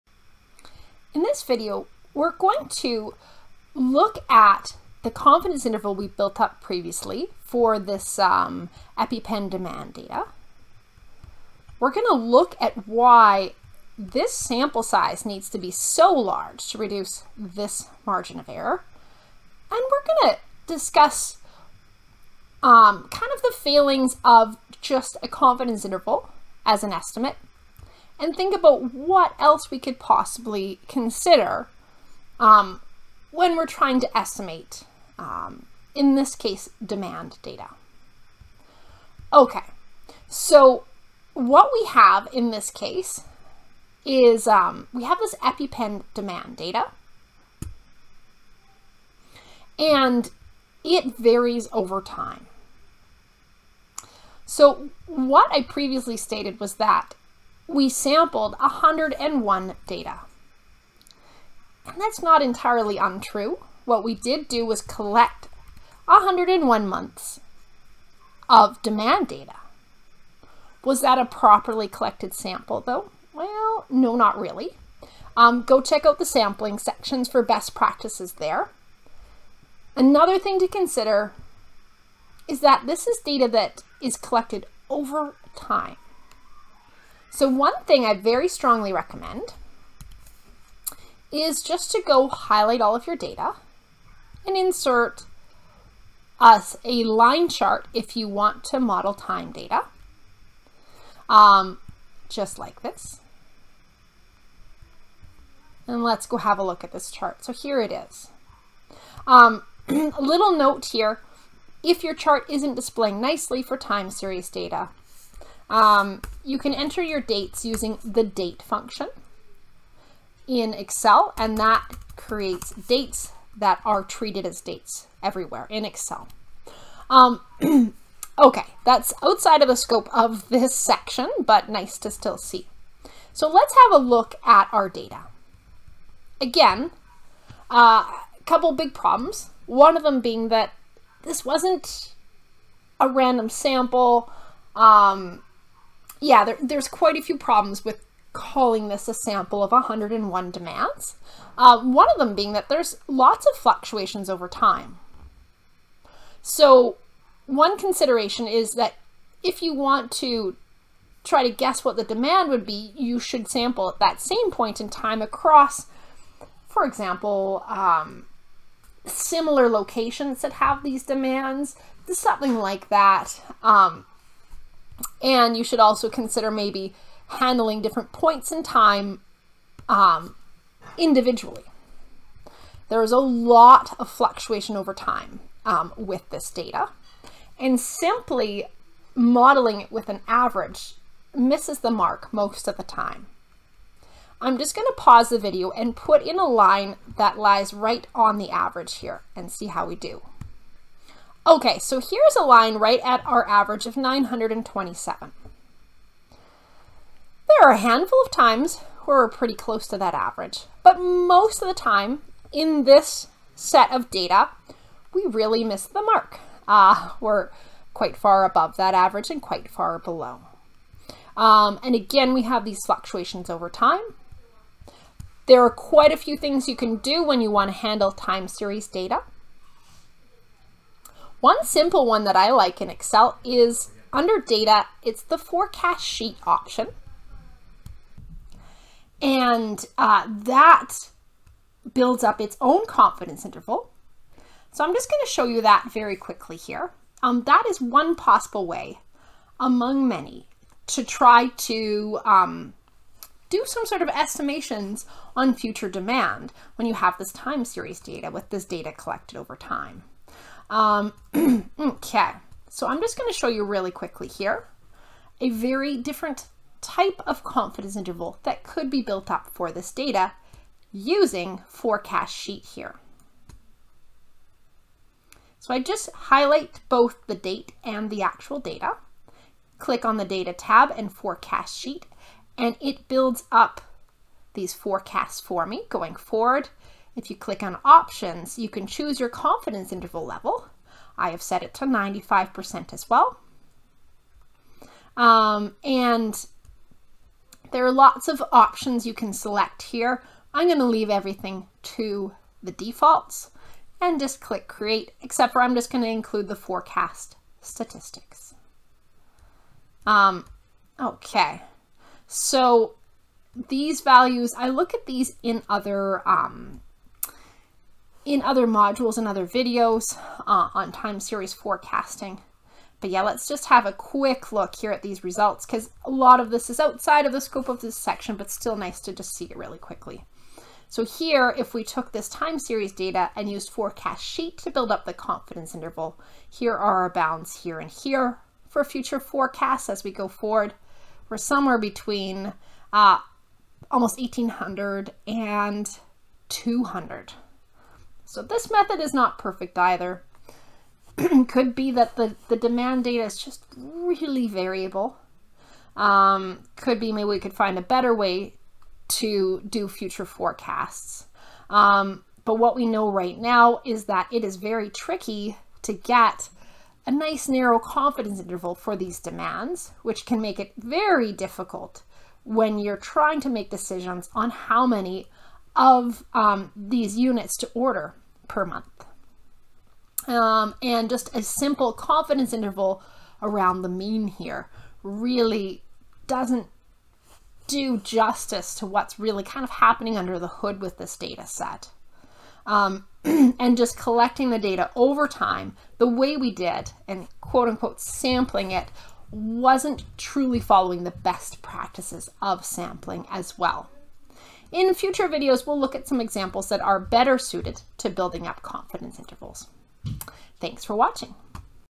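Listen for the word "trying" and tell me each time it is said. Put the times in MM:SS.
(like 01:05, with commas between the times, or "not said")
00:33, 06:12.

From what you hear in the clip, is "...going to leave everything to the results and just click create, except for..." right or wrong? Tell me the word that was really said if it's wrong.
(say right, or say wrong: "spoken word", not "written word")
wrong: "defaults", not "results".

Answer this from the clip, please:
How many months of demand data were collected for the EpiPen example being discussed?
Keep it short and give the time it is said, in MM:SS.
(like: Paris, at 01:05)
101, at 01:06.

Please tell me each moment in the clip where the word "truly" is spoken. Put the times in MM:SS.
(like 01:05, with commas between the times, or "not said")
06:40.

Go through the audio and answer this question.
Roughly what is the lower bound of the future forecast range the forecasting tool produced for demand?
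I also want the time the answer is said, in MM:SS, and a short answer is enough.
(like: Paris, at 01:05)
200, at 05:46.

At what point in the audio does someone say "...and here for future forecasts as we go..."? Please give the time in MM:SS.
05:37.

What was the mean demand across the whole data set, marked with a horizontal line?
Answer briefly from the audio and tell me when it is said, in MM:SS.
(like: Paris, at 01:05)
927, at 03:23.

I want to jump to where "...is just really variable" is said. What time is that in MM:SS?
05:53.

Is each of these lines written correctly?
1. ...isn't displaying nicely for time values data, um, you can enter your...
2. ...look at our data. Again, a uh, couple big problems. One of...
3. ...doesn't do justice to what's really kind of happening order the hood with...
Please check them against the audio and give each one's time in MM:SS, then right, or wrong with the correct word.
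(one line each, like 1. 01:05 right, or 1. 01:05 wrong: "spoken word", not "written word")
1. 01:52 wrong: "series", not "values"
2. 02:14 right
3. 06:26 wrong: "under", not "order".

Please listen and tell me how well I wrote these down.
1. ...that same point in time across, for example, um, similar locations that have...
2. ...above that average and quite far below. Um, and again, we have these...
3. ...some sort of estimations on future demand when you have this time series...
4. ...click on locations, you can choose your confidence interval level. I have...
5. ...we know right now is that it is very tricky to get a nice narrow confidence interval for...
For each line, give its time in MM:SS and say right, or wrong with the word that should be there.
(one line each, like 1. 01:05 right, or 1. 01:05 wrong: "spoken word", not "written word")
1. 02:43 right
2. 03:38 right
3. 04:13 right
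4. 04:47 wrong: "options", not "locations"
5. 06:02 right.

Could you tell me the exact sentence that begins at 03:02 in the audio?
There is a lot of fluctuation over time um, with this data.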